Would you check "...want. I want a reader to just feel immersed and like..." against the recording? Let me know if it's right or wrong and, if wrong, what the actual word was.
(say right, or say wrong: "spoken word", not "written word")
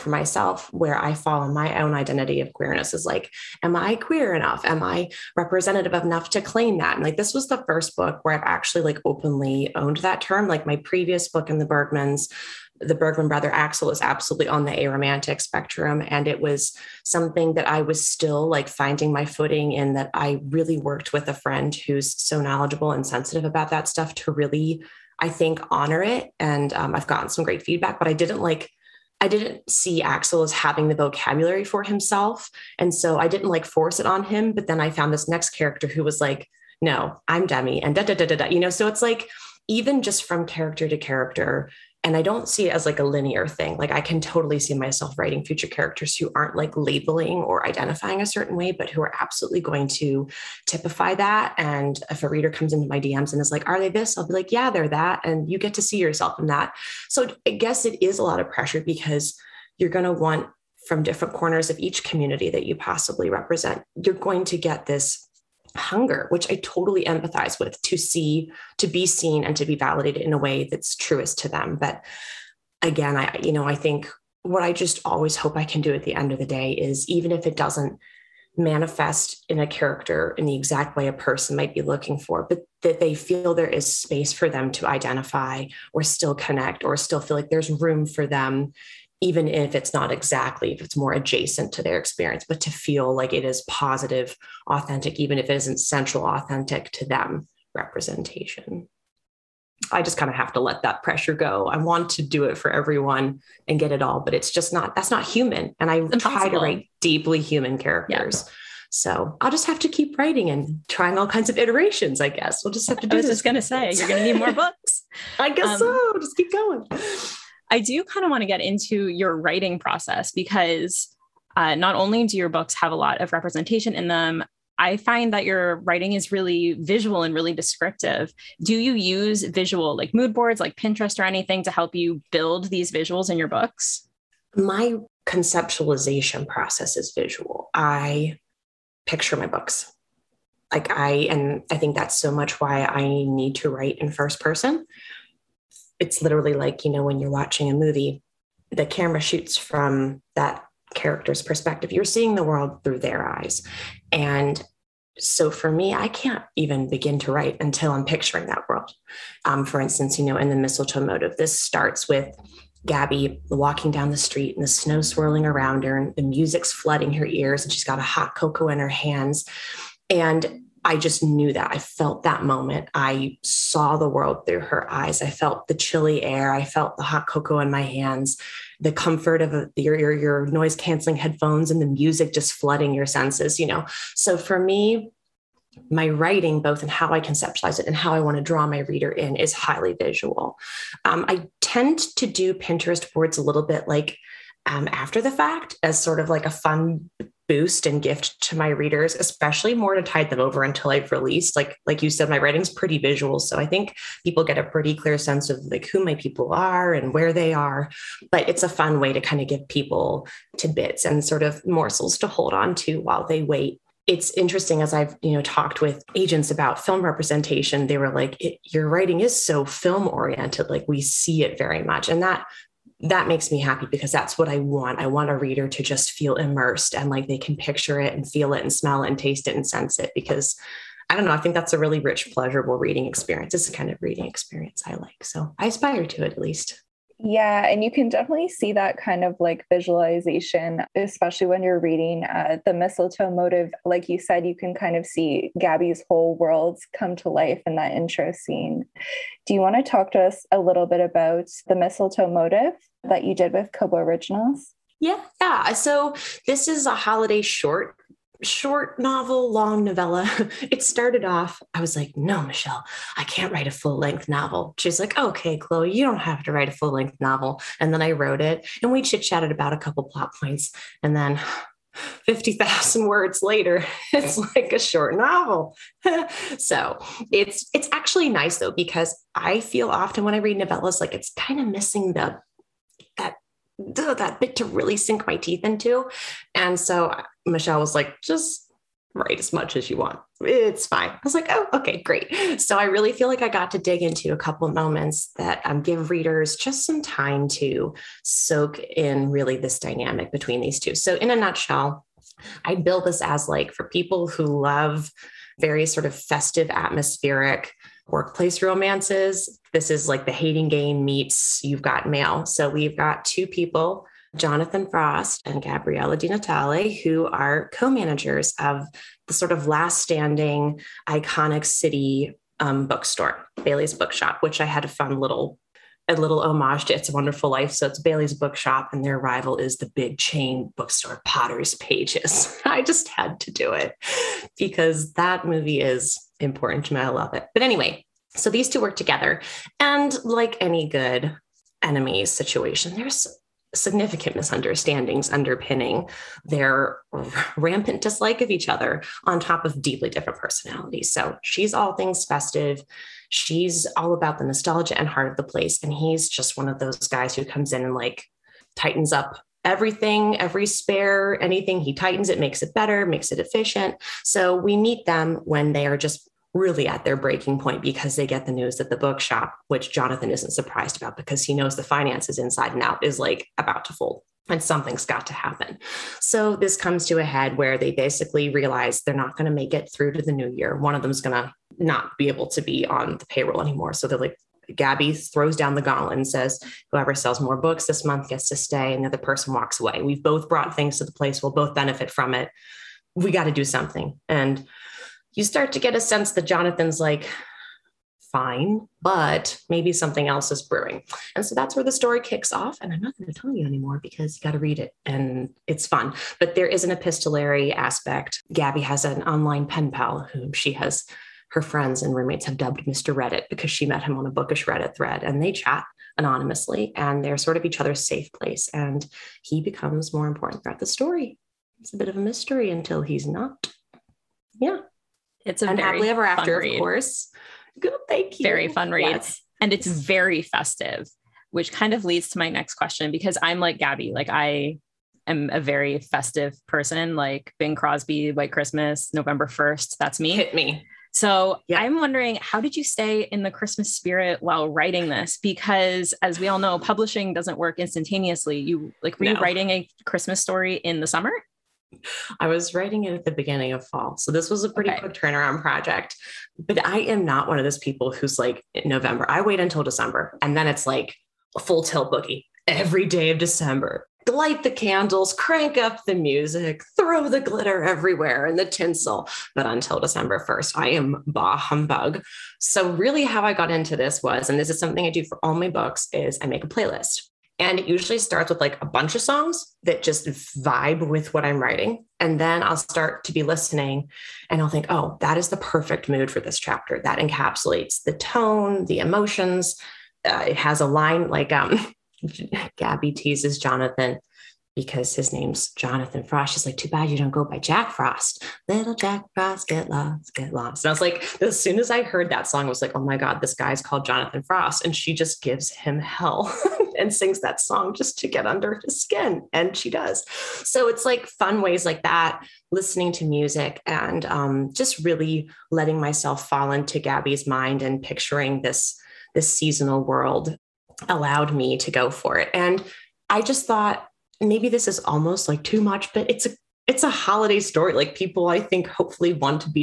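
right.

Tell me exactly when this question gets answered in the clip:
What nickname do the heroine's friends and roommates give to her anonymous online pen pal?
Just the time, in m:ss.
6:52.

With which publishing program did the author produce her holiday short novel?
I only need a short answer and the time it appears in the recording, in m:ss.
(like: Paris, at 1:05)
Kobo Originals, at 4:13.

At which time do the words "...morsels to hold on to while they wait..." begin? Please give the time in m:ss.
3:31.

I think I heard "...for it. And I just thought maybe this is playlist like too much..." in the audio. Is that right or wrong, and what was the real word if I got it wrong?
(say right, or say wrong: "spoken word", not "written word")
wrong: "almost", not "playlist".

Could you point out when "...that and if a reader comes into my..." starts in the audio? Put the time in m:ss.
0:51.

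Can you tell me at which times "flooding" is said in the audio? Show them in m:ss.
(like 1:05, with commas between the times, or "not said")
2:46, 3:02.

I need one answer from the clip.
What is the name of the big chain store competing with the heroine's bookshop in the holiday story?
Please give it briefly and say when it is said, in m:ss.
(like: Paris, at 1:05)
Potter's Pages, at 5:31.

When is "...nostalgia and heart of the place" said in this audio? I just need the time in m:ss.
5:54.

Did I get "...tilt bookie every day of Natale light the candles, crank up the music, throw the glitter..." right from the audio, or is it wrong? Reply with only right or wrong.
wrong.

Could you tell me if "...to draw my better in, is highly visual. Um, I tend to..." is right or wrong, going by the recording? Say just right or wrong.
wrong.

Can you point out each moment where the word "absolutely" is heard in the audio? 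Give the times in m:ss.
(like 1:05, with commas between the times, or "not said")
0:14, 0:49.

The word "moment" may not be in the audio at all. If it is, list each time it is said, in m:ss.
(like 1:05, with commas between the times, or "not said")
2:52, 4:54.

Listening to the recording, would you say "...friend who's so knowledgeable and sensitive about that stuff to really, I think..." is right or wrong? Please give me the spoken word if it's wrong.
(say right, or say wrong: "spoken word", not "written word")
right.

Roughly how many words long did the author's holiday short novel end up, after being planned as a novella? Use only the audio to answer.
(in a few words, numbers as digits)
50,000.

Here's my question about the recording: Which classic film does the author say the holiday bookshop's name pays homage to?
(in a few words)
It's a Wonderful Life.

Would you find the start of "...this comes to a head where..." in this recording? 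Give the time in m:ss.
6:16.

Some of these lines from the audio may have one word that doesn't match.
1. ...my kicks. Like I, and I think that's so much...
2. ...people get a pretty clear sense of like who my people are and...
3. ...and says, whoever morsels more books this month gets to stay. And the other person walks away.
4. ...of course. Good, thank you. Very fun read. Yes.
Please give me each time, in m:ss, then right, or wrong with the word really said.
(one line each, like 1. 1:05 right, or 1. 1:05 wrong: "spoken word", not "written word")
1. 2:19 wrong: "books", not "kicks"
2. 3:24 right
3. 6:26 wrong: "sells", not "morsels"
4. 7:06 right.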